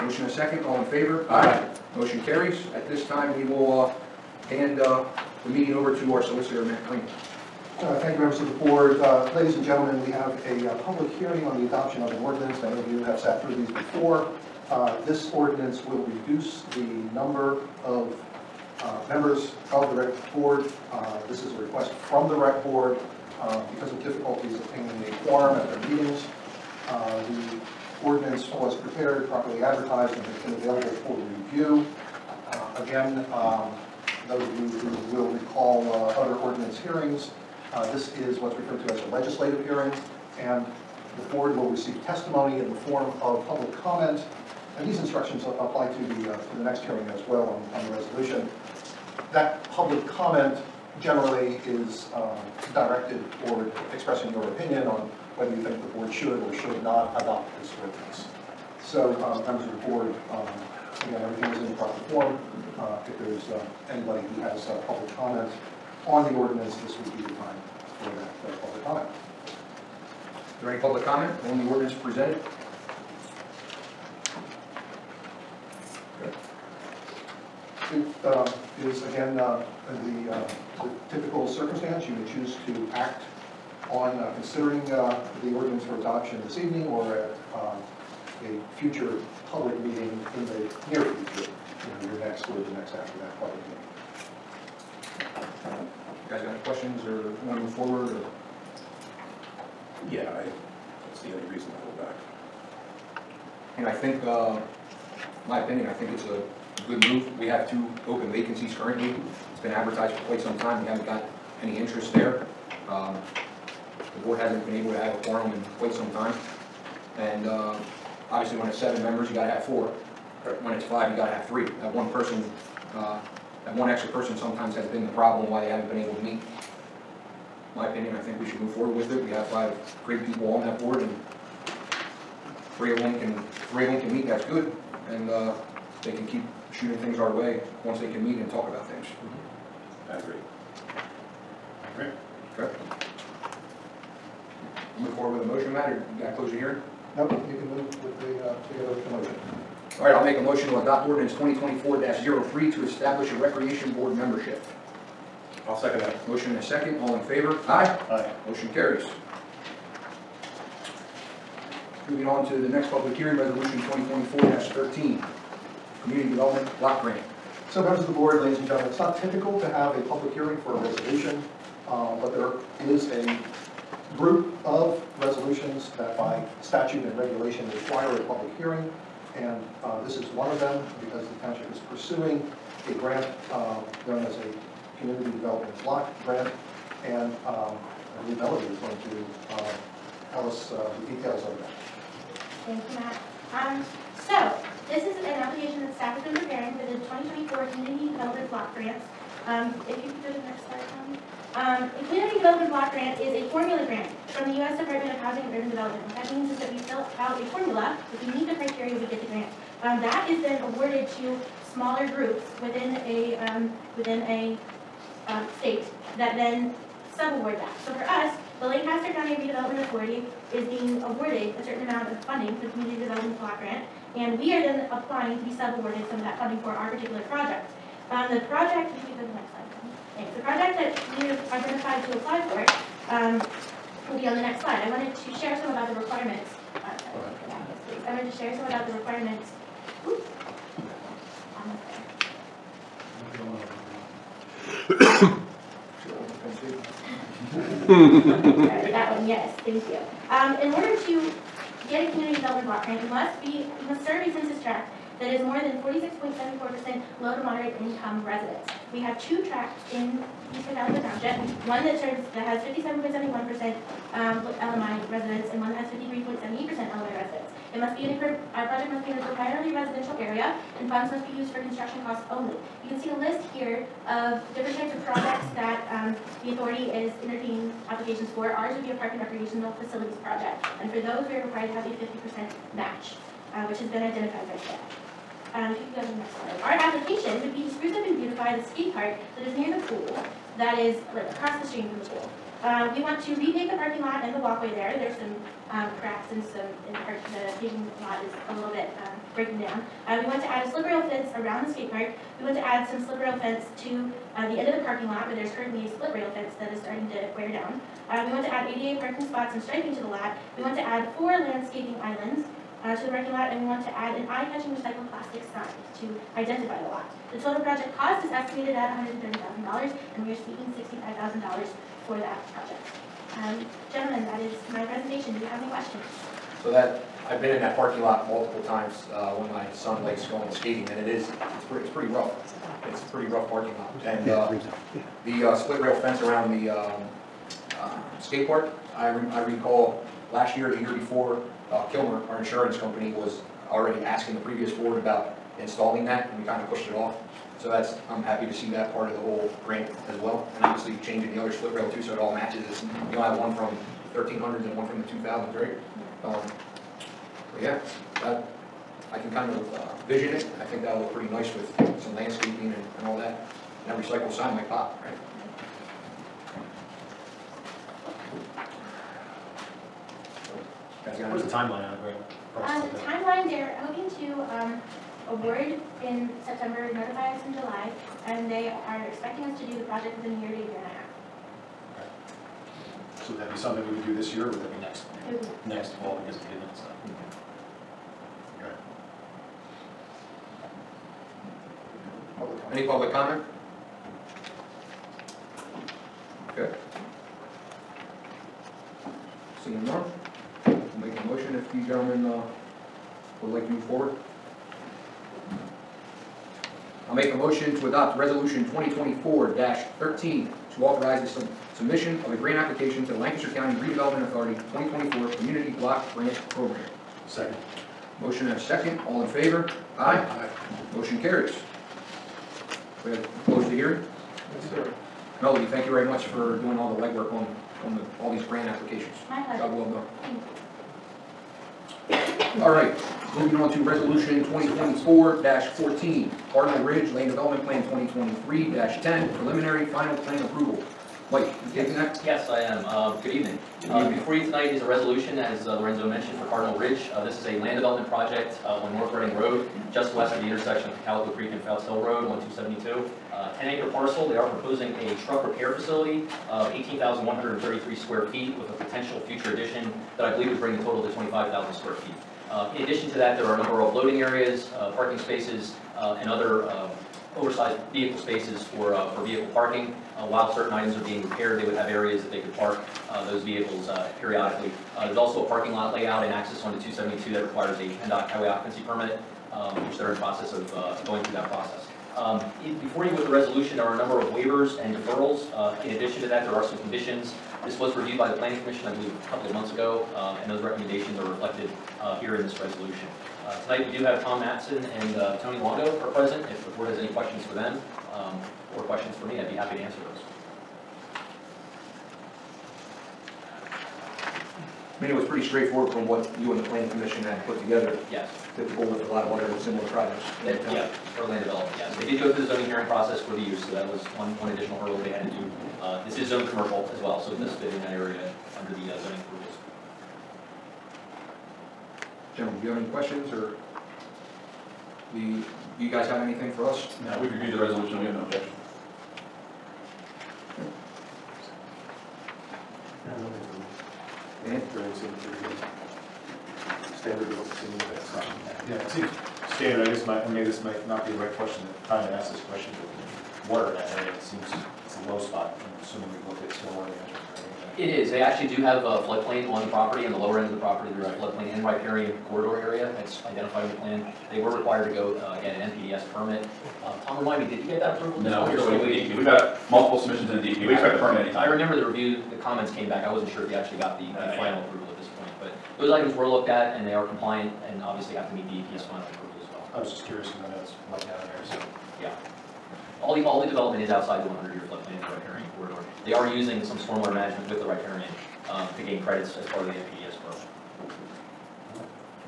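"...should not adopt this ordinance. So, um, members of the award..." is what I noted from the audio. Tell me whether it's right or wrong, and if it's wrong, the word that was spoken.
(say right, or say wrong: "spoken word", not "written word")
wrong: "board", not "award".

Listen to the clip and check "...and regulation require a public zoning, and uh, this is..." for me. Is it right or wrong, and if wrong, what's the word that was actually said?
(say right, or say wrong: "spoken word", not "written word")
wrong: "hearing", not "zoning".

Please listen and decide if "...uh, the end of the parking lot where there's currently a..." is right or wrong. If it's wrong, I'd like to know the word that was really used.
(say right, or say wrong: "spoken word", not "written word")
right.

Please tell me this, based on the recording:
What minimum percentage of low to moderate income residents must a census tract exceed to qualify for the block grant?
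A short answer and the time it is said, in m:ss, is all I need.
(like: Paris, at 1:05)
46.74%, at 4:15.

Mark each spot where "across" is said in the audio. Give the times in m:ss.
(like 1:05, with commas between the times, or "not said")
4:51.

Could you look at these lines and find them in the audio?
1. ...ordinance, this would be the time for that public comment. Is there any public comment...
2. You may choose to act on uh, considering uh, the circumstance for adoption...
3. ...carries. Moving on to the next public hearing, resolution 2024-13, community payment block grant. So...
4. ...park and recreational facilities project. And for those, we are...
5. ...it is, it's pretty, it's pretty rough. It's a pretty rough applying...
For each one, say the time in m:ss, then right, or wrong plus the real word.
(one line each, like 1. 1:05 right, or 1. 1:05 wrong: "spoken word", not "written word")
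1. 1:06 right
2. 1:22 wrong: "ordinance", not "circumstance"
3. 2:38 wrong: "development", not "payment"
4. 4:38 right
5. 5:30 wrong: "parking", not "applying".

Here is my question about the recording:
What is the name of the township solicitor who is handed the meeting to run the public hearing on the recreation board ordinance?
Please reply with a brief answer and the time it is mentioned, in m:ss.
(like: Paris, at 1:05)
Matt Crane, at 0:06.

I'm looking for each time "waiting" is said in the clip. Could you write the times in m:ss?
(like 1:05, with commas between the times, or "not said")
9:18.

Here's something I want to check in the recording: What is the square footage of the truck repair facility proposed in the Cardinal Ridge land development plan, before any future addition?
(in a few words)
18,133 square feet.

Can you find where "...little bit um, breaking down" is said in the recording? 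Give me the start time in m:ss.
4:58.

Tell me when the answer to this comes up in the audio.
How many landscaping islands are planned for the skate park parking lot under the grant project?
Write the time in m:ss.
5:11.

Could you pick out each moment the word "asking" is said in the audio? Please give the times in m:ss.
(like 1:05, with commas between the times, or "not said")
5:44.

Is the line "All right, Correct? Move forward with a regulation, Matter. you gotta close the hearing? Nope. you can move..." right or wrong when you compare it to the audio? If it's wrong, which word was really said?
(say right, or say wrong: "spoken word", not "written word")
wrong: "motion", not "regulation".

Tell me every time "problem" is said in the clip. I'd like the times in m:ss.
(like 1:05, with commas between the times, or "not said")
2:05.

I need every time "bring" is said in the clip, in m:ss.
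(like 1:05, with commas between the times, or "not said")
7:40.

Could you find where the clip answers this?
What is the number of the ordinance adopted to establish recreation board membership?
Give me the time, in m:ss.
2:31.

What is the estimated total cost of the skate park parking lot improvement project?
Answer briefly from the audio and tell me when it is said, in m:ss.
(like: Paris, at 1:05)
$130,000, at 5:18.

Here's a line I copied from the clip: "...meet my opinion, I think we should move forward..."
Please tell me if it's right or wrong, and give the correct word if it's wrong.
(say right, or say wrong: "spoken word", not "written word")
right.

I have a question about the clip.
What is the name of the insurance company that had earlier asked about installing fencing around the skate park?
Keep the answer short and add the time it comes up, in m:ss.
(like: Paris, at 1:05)
Kilmer, at 5:41.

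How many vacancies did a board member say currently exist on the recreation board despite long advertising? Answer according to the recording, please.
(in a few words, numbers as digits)
2.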